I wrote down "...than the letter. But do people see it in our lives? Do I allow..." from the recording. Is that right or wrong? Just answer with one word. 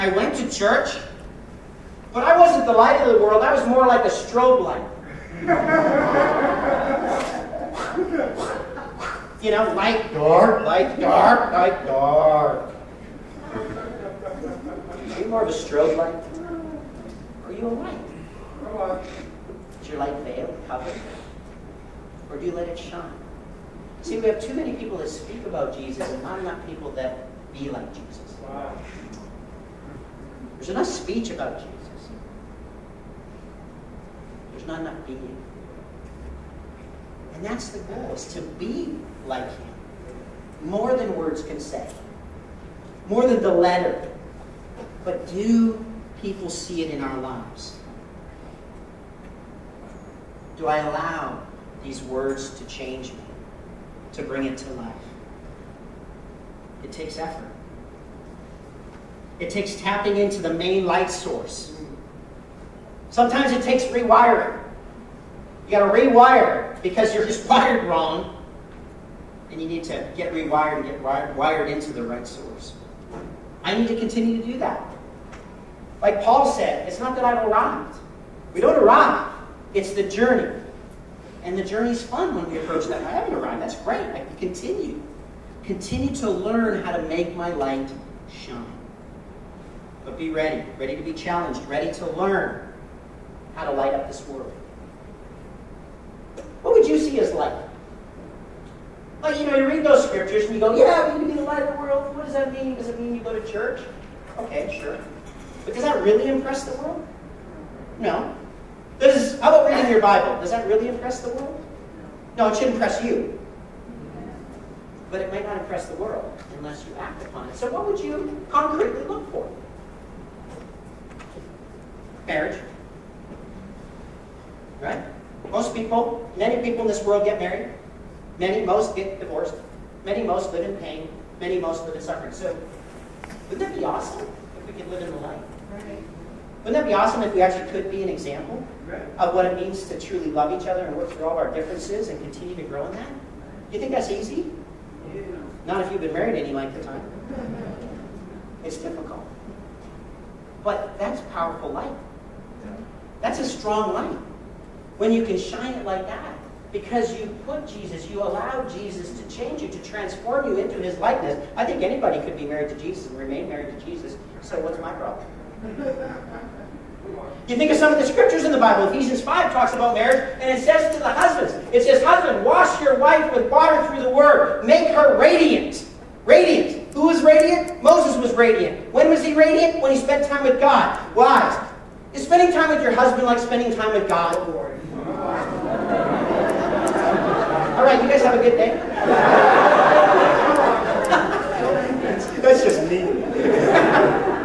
right.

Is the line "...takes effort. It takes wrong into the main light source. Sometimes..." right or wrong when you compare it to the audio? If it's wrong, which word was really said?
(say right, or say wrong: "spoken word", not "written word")
wrong: "tapping", not "wrong".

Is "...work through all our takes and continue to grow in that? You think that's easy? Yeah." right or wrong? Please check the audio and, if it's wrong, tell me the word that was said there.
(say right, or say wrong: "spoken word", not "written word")
wrong: "differences", not "takes".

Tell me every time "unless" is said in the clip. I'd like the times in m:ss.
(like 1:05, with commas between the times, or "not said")
1:56.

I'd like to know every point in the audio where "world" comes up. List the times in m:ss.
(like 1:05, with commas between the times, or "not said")
0:03, 1:34, 1:41, 1:46, 1:51, 1:55, 2:07.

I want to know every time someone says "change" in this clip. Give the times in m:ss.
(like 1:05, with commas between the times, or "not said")
0:52, 2:39.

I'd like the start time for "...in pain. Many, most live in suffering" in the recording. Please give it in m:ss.
2:10.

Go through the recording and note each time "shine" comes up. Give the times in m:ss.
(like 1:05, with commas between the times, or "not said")
0:22, 1:28, 2:35.